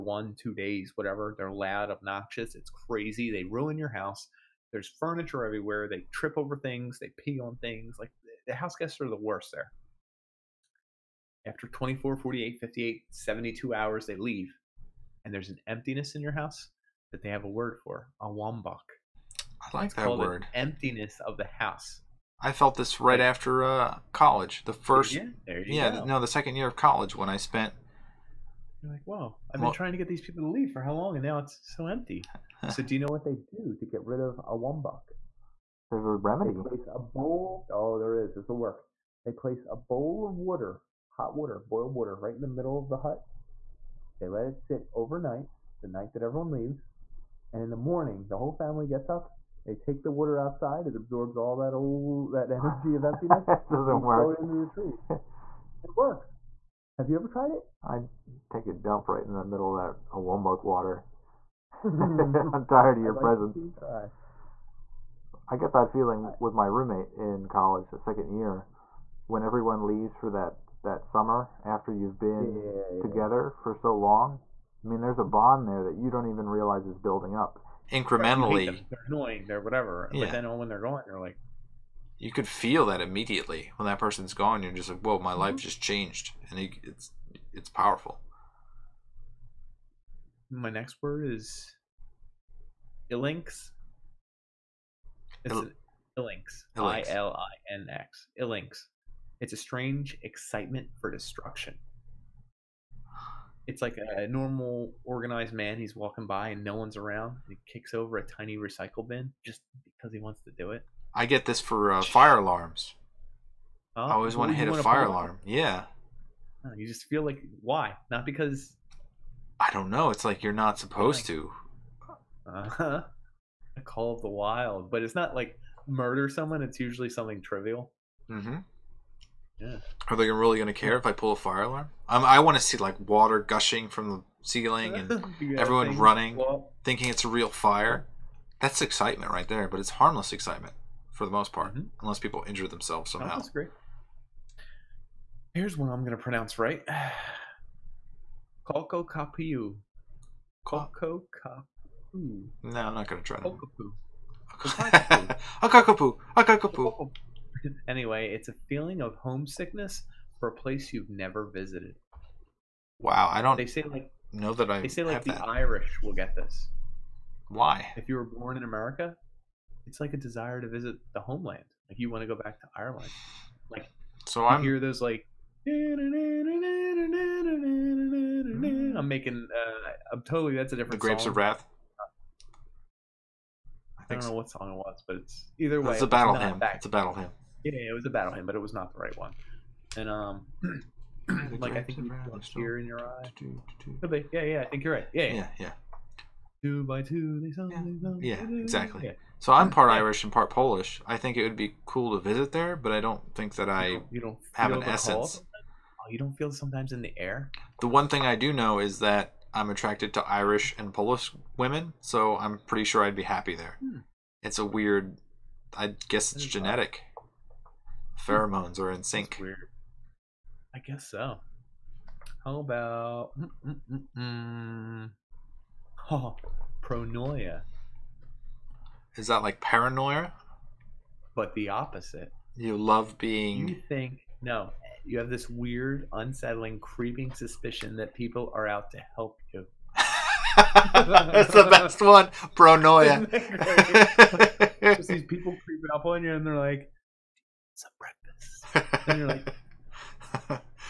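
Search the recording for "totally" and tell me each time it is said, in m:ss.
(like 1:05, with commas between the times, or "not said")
3:00.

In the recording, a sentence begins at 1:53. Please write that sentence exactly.
Oh, I always want to hit a fire alarm.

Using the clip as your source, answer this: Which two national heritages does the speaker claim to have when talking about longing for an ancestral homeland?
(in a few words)
Irish and Polish.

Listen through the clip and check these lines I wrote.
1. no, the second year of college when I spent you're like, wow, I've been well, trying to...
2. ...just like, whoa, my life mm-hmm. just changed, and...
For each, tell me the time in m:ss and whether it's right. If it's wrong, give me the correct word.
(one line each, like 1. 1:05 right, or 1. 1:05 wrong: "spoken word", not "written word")
1. 0:26 right
2. 1:24 right.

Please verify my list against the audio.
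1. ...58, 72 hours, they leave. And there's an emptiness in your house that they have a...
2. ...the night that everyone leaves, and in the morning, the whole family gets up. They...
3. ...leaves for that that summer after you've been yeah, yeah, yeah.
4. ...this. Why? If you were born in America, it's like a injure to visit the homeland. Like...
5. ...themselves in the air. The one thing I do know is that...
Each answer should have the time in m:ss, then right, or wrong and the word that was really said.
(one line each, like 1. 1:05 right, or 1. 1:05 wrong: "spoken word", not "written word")
1. 0:12 right
2. 0:45 right
3. 1:09 right
4. 2:46 wrong: "desire", not "injure"
5. 3:26 wrong: "sometimes", not "themselves".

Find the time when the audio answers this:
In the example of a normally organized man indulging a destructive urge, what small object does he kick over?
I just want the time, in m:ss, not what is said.
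1:48.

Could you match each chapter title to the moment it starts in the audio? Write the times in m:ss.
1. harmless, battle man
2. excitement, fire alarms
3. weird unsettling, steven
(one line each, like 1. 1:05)
1. 2:01
2. 1:01
3. 3:01.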